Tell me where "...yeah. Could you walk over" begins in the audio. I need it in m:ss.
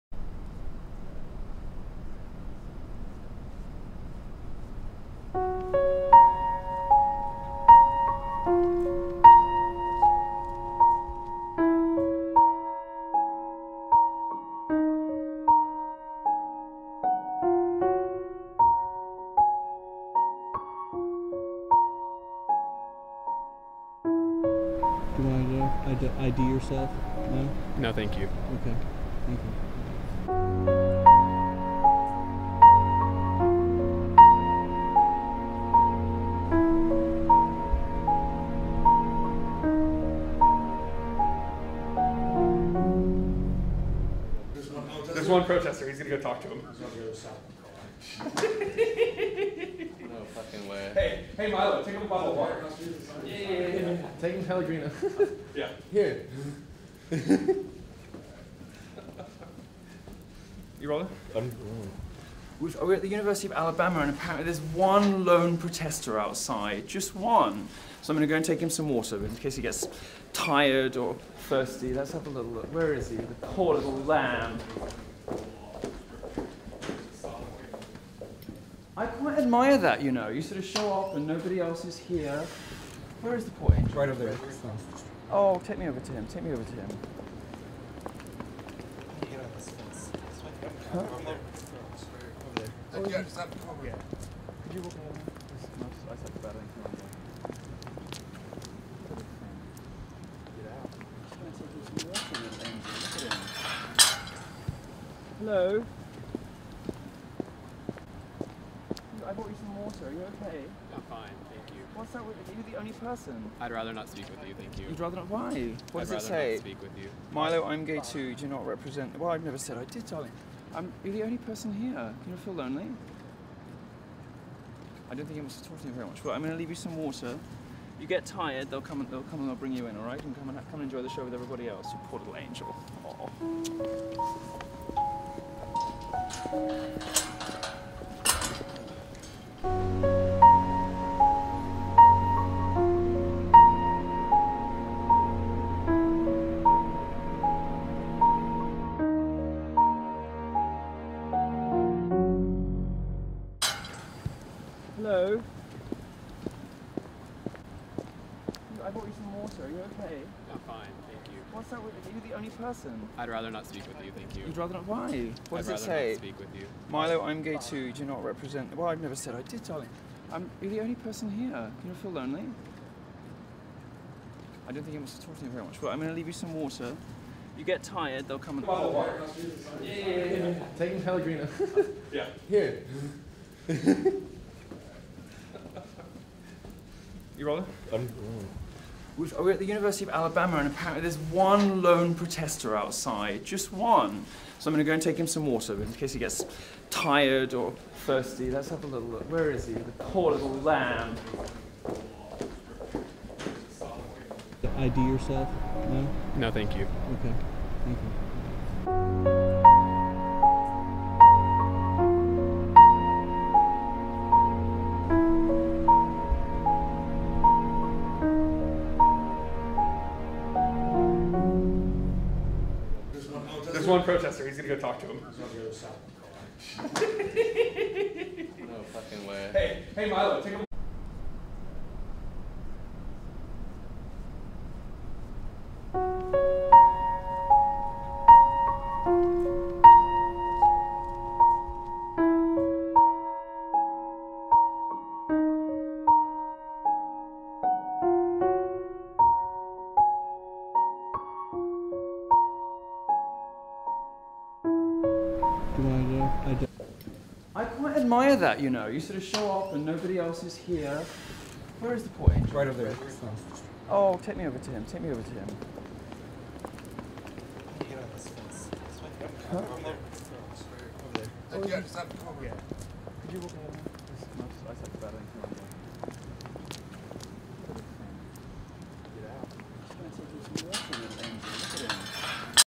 1:33.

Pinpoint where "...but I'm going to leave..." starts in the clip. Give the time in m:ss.
2:55.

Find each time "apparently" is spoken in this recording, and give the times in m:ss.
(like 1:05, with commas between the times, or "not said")
1:04, 3:10.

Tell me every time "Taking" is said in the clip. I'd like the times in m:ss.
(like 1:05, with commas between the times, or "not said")
0:54, 3:00.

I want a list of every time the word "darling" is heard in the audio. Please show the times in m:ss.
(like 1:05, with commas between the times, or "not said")
2:00, 2:49.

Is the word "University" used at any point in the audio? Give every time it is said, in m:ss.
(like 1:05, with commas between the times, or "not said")
1:03, 3:09.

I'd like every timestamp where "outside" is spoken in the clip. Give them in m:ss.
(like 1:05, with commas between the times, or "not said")
1:06, 3:12.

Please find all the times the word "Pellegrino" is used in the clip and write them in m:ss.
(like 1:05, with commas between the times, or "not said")
0:54, 3:01.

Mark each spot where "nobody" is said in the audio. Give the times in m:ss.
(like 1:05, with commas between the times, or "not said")
1:21, 4:19.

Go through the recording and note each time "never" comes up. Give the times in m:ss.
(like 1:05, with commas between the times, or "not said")
1:59, 2:49.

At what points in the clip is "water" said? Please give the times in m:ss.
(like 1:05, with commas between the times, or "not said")
0:52, 1:08, 1:49, 2:06, 2:39, 2:56, 3:15.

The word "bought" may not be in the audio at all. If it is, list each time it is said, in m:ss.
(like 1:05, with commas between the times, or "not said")
1:49, 2:35.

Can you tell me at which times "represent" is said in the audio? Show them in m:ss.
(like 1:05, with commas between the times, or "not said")
1:58, 2:48.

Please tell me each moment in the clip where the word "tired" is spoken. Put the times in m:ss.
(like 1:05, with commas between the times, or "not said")
1:10, 2:08, 2:57, 3:16.